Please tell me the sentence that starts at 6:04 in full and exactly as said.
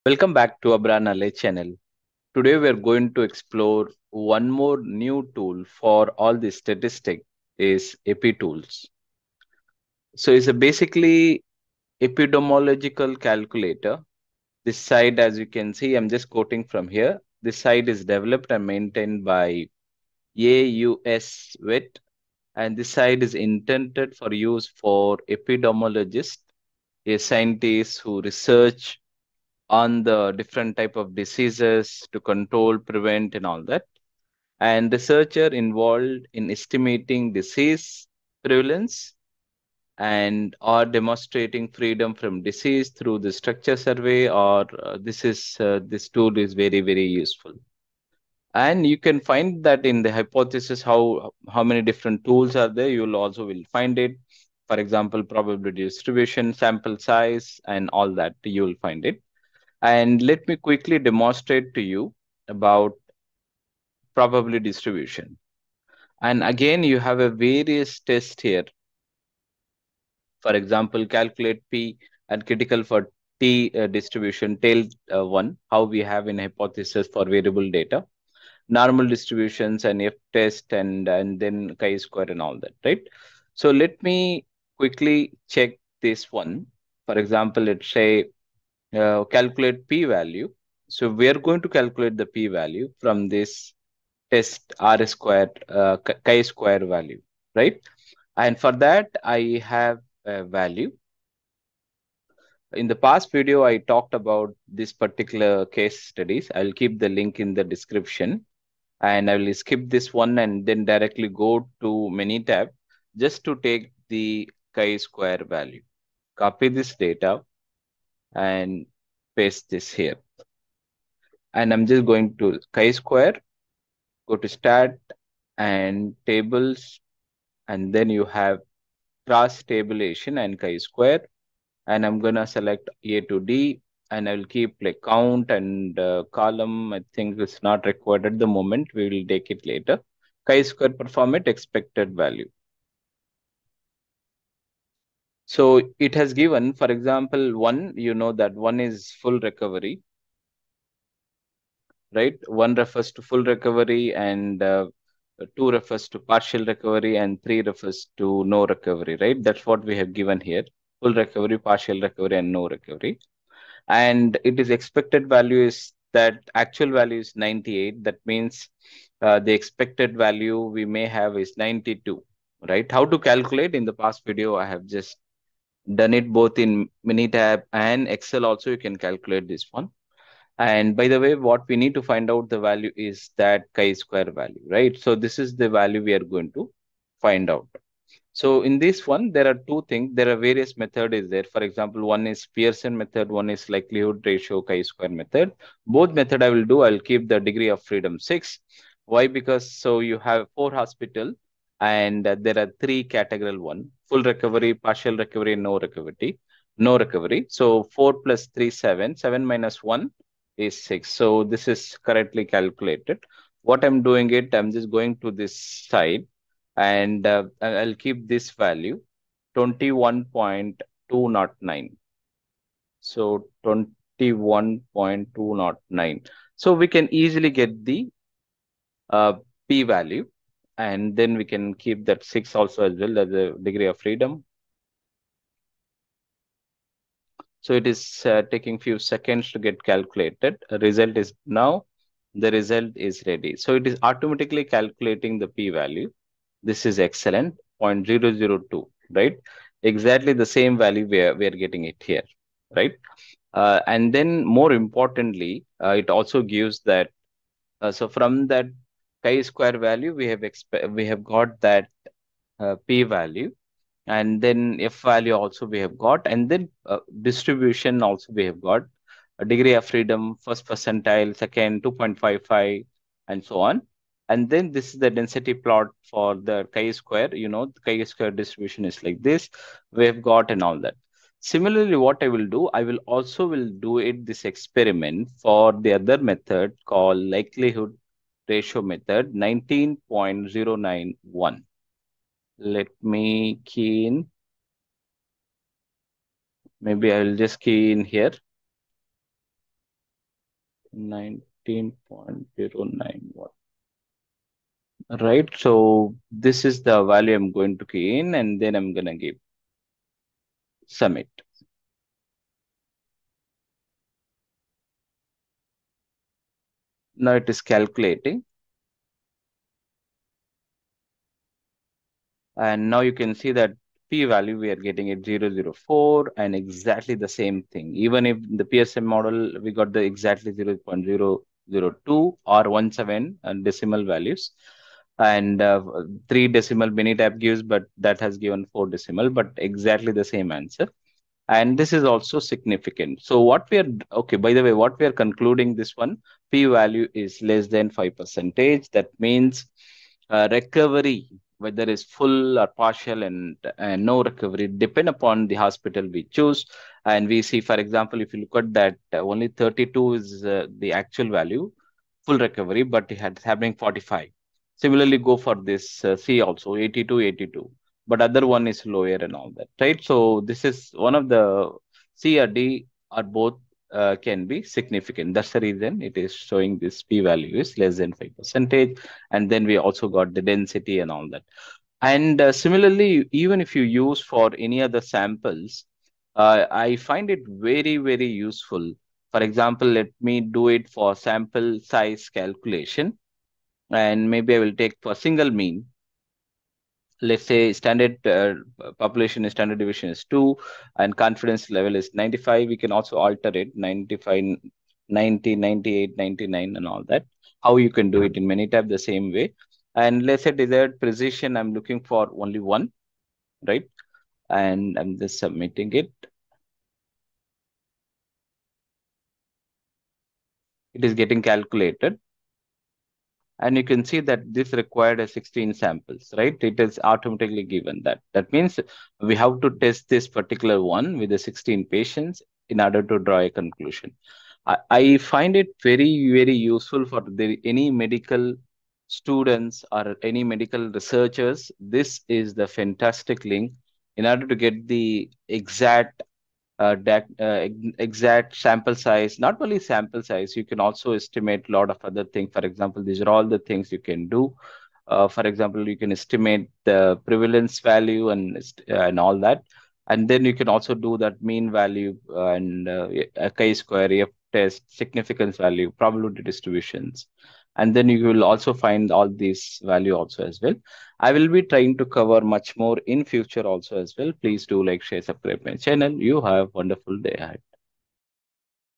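Similarly, go for this uh, C also, 82, 82.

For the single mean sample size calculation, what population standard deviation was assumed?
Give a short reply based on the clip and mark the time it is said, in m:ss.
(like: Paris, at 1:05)
2, at 6:40.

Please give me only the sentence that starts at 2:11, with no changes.
And I'm going to select A to D and I'll keep like count and uh, column.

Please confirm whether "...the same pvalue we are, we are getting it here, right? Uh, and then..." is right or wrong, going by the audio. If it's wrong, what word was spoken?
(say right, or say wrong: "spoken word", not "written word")
wrong: "value", not "pvalue".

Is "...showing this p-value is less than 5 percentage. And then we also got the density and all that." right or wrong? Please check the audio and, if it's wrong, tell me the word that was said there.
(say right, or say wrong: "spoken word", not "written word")
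right.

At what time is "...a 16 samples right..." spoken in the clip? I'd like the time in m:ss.
7:05.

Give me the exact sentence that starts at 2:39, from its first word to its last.
That's what we have given here, full recovery, partial recovery and no recovery.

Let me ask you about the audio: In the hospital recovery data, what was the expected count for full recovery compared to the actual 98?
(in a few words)
92.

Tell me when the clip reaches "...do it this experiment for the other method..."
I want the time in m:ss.
4:43.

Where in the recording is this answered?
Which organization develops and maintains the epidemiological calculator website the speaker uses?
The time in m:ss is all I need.
0:20.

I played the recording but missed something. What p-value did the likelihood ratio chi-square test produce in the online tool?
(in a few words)
0.004.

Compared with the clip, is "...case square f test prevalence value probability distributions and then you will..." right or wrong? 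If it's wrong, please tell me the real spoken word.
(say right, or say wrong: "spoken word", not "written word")
wrong: "significance", not "prevalence".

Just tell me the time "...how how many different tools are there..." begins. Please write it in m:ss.
0:50.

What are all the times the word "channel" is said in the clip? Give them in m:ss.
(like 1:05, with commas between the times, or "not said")
0:01, 7:55.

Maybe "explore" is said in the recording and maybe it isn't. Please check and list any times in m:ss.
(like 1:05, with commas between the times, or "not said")
0:03.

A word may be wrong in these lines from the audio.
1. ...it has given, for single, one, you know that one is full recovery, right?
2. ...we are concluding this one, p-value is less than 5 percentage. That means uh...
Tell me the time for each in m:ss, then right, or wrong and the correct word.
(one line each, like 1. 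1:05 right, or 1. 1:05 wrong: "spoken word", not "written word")
1. 2:25 wrong: "example", not "single"
2. 5:44 right.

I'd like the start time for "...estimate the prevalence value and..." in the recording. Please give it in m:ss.
7:36.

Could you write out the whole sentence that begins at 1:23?
So let me quickly check this one.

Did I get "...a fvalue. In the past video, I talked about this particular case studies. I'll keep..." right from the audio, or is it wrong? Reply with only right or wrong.
wrong.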